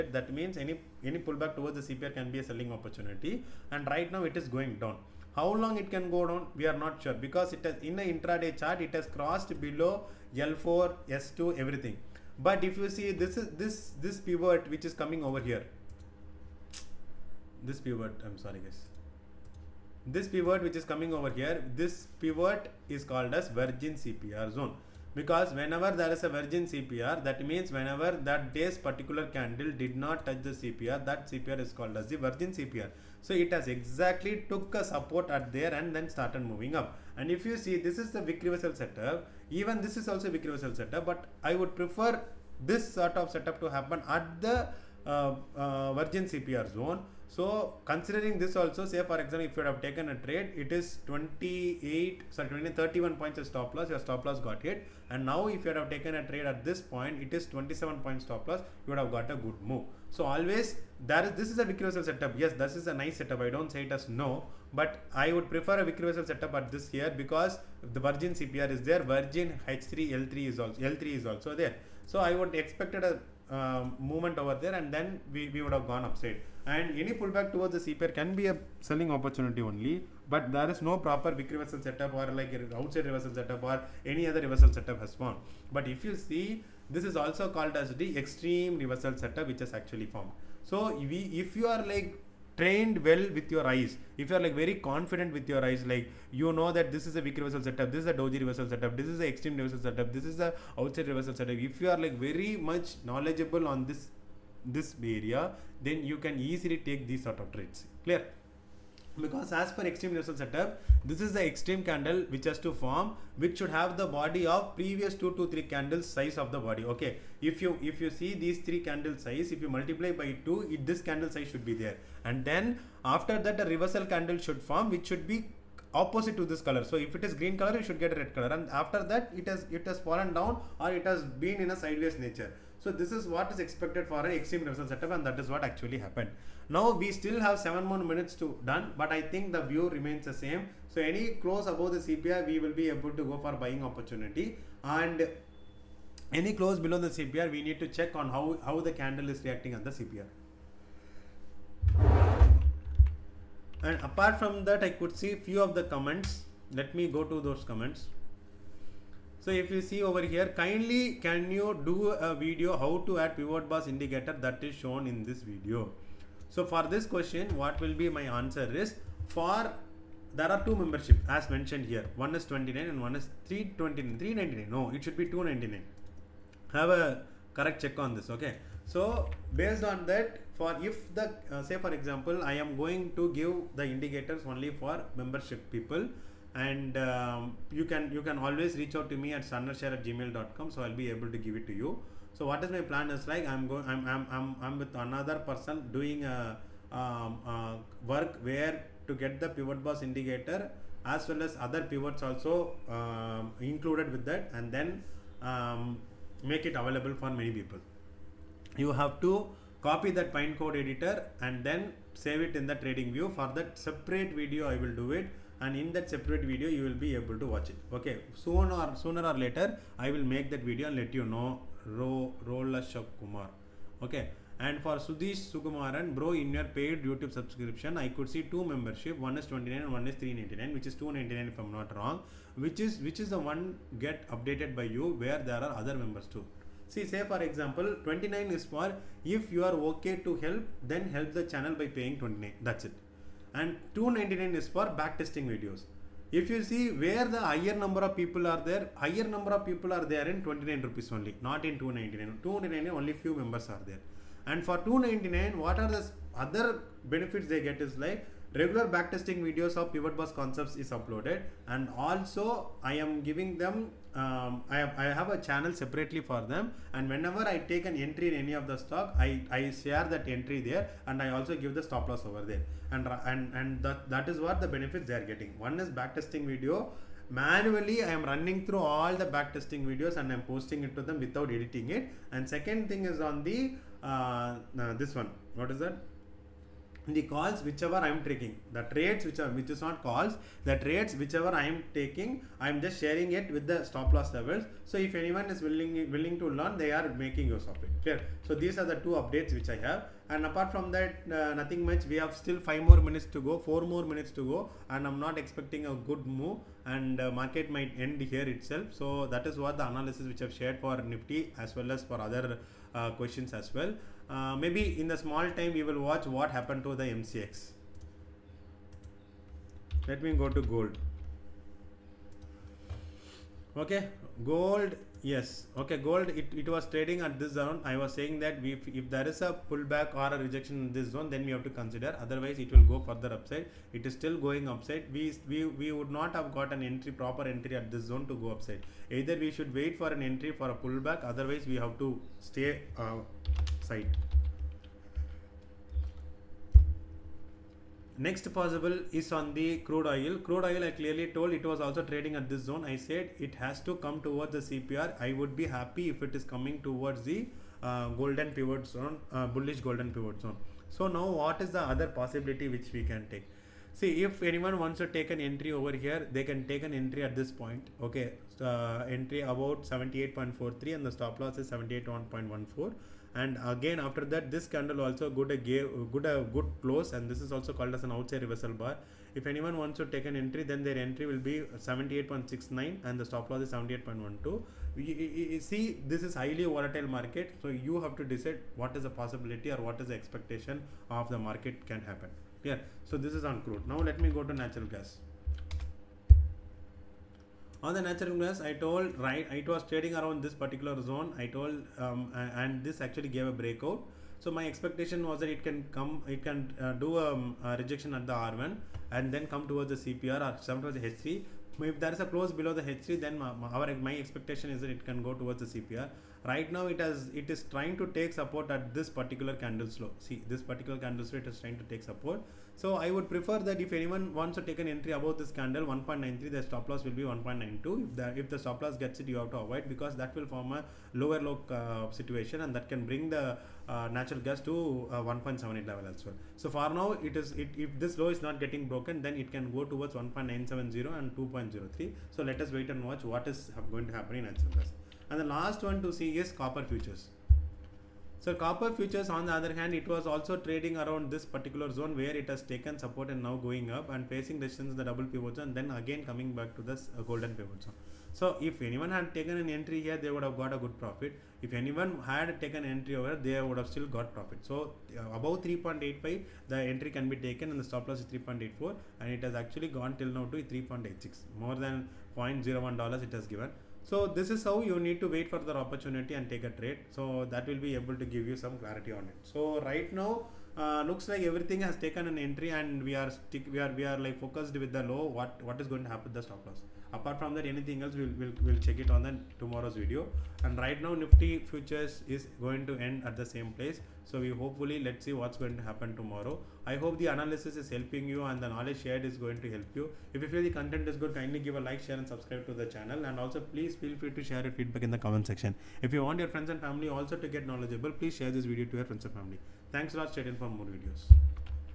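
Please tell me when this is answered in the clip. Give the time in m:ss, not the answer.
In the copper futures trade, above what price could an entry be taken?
7:45.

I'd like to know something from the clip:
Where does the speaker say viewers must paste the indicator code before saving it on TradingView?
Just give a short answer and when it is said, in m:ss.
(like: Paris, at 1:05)
Pine code editor, at 3:30.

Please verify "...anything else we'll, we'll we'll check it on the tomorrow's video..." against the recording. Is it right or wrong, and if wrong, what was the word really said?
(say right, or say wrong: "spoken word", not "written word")
right.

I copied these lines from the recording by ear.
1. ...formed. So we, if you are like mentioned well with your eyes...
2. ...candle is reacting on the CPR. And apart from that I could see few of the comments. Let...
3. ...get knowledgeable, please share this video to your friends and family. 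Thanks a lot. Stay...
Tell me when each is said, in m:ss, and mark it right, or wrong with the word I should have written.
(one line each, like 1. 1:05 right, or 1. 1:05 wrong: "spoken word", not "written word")
1. 1:30 wrong: "trained", not "mentioned"
2. 2:28 right
3. 8:27 right.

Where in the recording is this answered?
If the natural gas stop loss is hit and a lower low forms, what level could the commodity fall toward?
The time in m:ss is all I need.
7:15.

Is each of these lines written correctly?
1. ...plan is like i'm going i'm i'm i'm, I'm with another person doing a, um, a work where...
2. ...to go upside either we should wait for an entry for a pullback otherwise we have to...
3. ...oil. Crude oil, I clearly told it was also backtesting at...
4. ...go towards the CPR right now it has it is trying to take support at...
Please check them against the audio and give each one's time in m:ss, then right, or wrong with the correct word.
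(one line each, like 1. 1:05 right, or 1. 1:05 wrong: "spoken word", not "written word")
1. 3:12 right
2. 5:38 right
3. 5:50 wrong: "trading", not "backtesting"
4. 6:55 right.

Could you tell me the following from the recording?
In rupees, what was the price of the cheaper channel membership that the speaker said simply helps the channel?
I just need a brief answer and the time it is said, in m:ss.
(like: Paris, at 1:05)
29, at 4:10.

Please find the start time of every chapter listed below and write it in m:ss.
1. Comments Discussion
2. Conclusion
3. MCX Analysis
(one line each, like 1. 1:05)
1. 2:26
2. 7:56
3. 5:26.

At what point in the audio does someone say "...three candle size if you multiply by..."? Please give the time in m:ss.
1:58.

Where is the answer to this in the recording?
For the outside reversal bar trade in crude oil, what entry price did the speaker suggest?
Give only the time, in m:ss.
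6:21.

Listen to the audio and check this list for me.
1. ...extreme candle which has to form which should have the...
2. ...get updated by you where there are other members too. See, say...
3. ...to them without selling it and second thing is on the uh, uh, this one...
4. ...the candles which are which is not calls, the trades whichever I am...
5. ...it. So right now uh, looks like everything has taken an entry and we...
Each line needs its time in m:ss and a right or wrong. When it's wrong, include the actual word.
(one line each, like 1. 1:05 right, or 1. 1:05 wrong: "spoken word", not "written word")
1. 1:51 right
2. 3:53 right
3. 4:40 wrong: "editing", not "selling"
4. 4:48 wrong: "trades", not "candles"
5. 7:59 right.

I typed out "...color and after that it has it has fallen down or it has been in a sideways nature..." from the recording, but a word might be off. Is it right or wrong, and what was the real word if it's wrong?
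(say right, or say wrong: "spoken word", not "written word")
right.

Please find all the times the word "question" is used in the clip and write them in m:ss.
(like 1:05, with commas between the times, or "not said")
2:47, 5:13.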